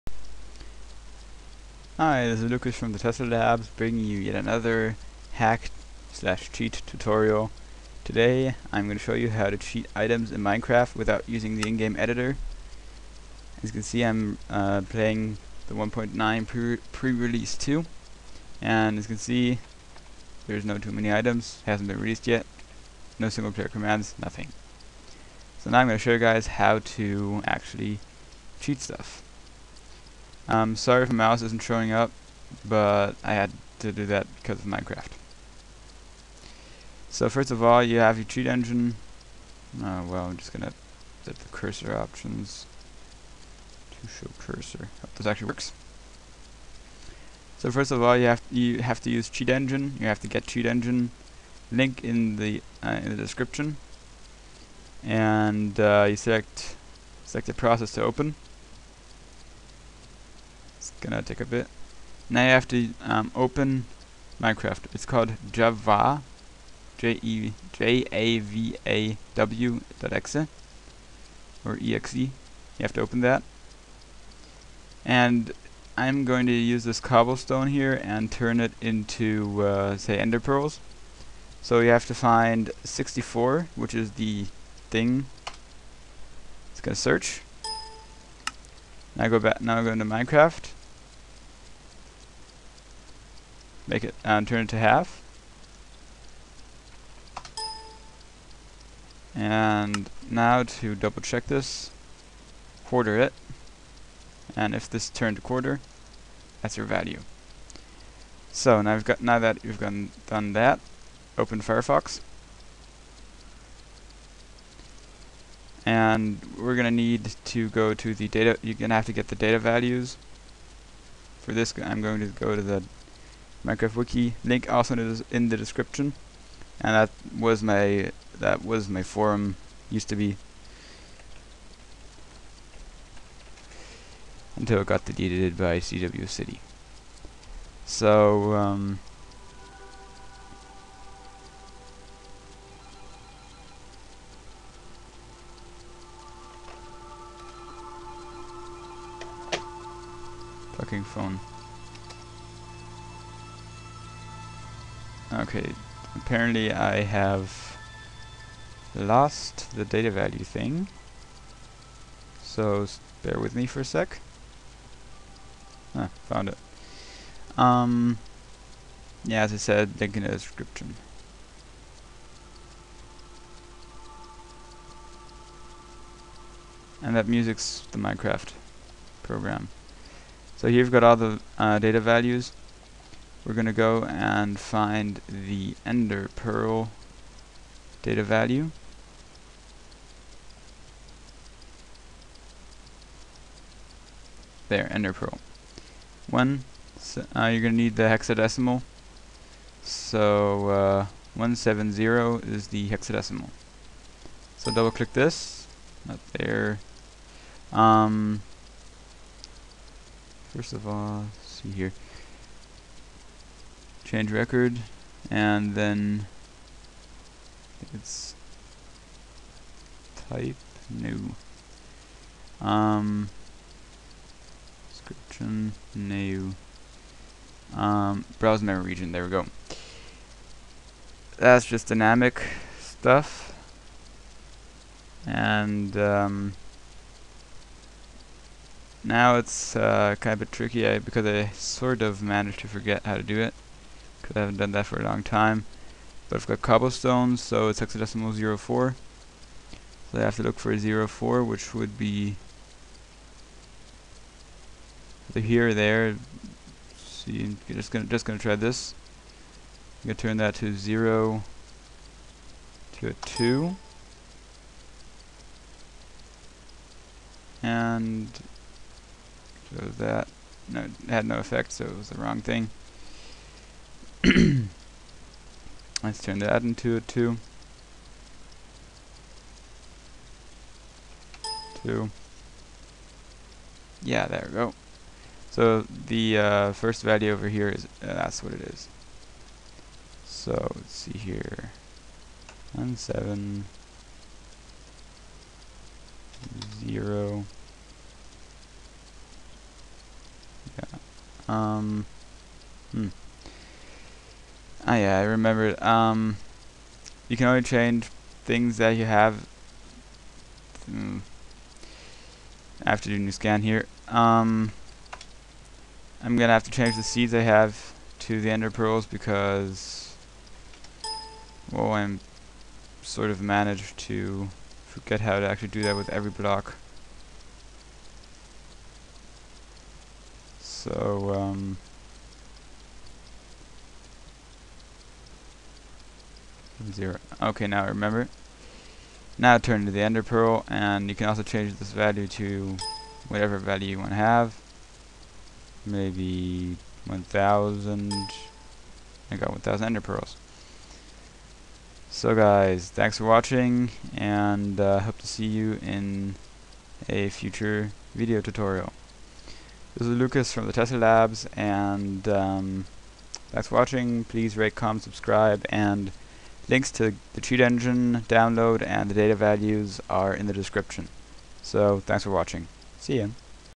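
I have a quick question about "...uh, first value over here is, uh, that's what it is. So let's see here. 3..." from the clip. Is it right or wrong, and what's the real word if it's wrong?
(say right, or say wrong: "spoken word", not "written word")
wrong: "1", not "3".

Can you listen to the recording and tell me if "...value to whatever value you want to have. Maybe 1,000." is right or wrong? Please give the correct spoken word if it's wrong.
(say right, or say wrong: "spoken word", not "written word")
right.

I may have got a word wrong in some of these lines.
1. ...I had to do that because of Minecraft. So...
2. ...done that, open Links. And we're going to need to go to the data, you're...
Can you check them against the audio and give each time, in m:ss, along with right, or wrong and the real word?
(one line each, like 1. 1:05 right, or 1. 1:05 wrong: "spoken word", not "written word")
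1. 0:33 right
2. 1:50 wrong: "Firefox", not "Links".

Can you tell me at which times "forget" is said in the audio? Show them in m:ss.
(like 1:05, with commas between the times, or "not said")
4:02, 5:24.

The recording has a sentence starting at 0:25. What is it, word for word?
So now I'm going to show you guys how to actually cheat stuff.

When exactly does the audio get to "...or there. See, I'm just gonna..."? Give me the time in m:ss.
4:15.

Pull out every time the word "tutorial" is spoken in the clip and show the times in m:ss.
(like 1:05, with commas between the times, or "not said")
0:06, 5:58.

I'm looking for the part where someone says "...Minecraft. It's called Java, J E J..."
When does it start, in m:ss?
1:04.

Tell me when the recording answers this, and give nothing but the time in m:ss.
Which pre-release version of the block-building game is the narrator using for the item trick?
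0:15.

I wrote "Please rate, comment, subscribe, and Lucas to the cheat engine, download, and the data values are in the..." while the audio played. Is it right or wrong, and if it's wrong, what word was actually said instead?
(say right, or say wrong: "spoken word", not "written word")
wrong: "Links", not "Lucas".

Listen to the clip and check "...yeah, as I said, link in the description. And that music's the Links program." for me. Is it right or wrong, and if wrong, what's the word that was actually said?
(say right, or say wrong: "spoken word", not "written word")
wrong: "Minecraft", not "Links".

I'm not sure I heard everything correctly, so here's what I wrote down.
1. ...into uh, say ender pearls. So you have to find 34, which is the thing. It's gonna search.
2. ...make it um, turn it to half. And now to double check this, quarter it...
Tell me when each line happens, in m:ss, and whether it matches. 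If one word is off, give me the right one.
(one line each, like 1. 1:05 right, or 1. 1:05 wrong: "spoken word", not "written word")
1. 1:18 wrong: "64", not "34"
2. 1:33 right.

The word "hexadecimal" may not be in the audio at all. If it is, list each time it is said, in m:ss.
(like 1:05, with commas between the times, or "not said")
3:18, 3:22, 4:07.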